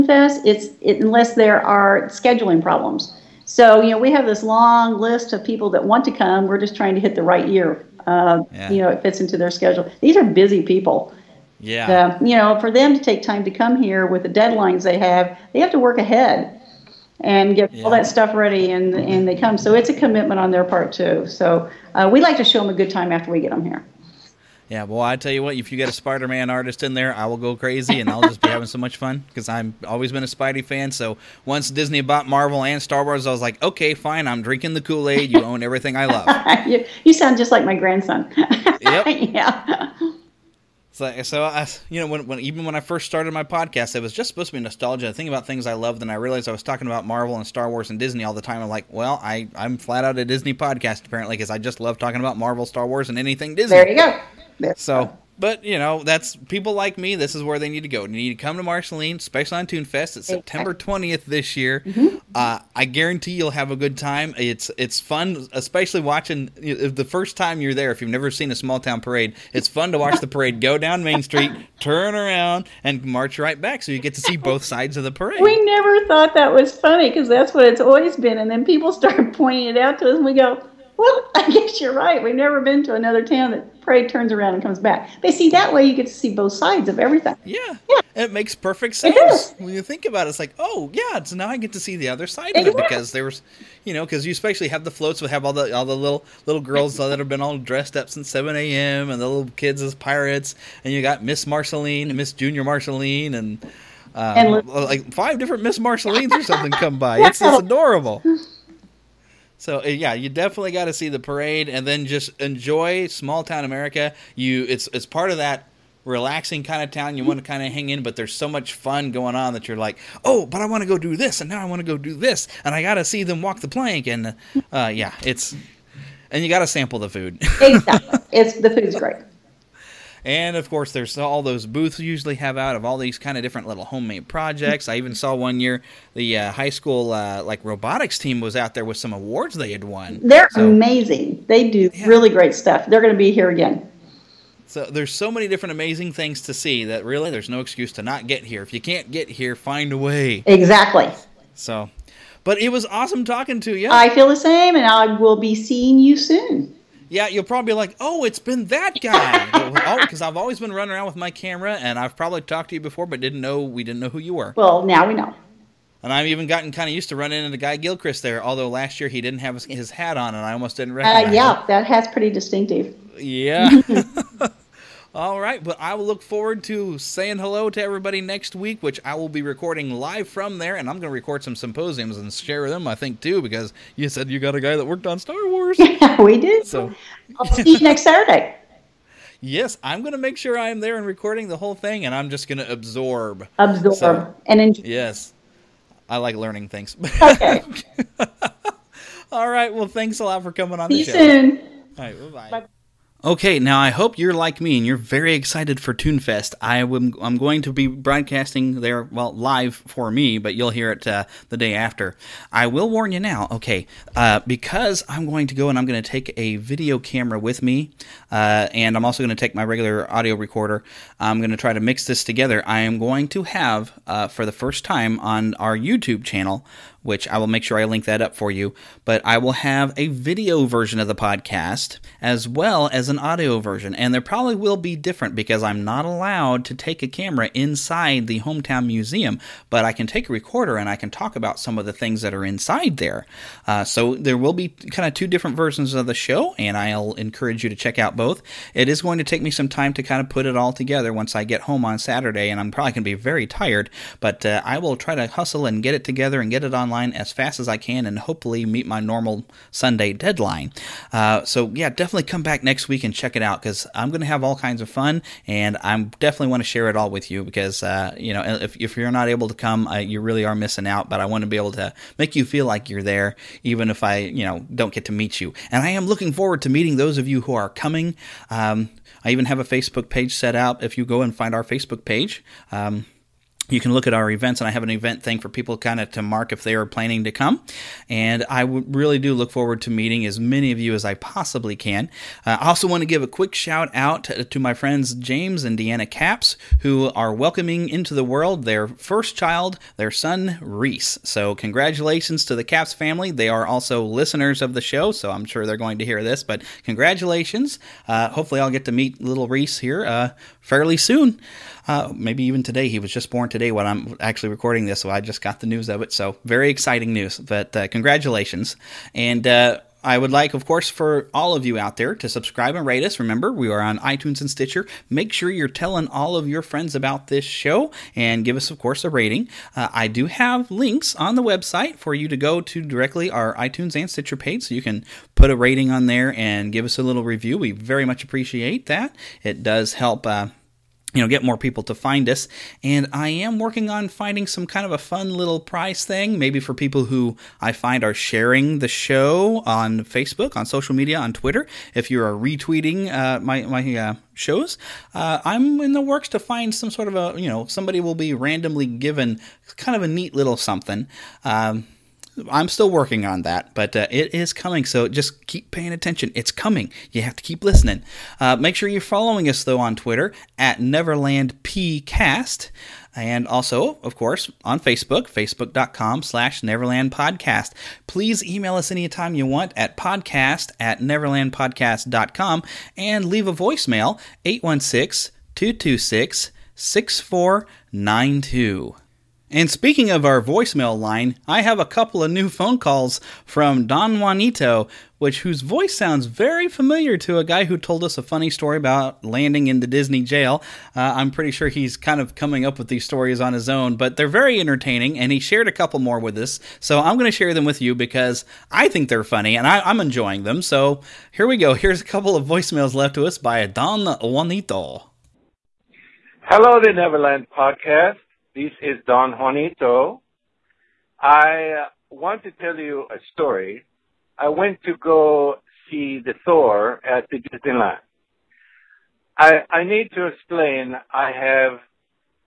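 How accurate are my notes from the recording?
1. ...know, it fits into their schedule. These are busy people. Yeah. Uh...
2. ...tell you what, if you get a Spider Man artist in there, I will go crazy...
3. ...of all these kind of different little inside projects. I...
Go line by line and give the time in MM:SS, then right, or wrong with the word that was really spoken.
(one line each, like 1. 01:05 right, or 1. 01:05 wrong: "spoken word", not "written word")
1. 00:08 right
2. 00:25 right
3. 02:12 wrong: "homemade", not "inside".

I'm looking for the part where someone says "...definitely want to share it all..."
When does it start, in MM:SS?
04:26.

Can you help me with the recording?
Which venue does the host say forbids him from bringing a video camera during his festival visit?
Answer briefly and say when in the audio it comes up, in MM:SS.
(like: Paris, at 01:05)
Hometown Museum, at 03:58.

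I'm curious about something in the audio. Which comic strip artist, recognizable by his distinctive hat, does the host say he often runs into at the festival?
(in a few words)
Guy Gilchrist.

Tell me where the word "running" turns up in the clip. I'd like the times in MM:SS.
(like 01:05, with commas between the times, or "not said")
02:40, 02:47.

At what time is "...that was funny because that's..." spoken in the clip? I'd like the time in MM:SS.
01:16.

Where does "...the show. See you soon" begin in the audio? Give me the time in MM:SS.
03:21.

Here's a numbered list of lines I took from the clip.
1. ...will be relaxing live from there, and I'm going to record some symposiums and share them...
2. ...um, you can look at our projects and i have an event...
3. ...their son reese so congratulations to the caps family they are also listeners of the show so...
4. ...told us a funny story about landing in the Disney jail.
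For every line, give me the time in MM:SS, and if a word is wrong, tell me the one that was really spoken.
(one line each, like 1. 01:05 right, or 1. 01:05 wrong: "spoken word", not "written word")
1. 02:59 wrong: "recording", not "relaxing"
2. 04:42 wrong: "events", not "projects"
3. 04:59 right
4. 06:37 right.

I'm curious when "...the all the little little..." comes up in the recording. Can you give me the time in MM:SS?
01:35.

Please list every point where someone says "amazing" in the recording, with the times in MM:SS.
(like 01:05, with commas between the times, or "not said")
02:20, 02:25.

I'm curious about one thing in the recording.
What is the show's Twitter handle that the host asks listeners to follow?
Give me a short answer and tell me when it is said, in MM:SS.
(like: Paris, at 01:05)
NeverlandPcast, at 06:10.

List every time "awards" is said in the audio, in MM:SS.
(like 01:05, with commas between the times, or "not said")
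02:19.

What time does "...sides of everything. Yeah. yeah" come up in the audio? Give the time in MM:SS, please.
01:26.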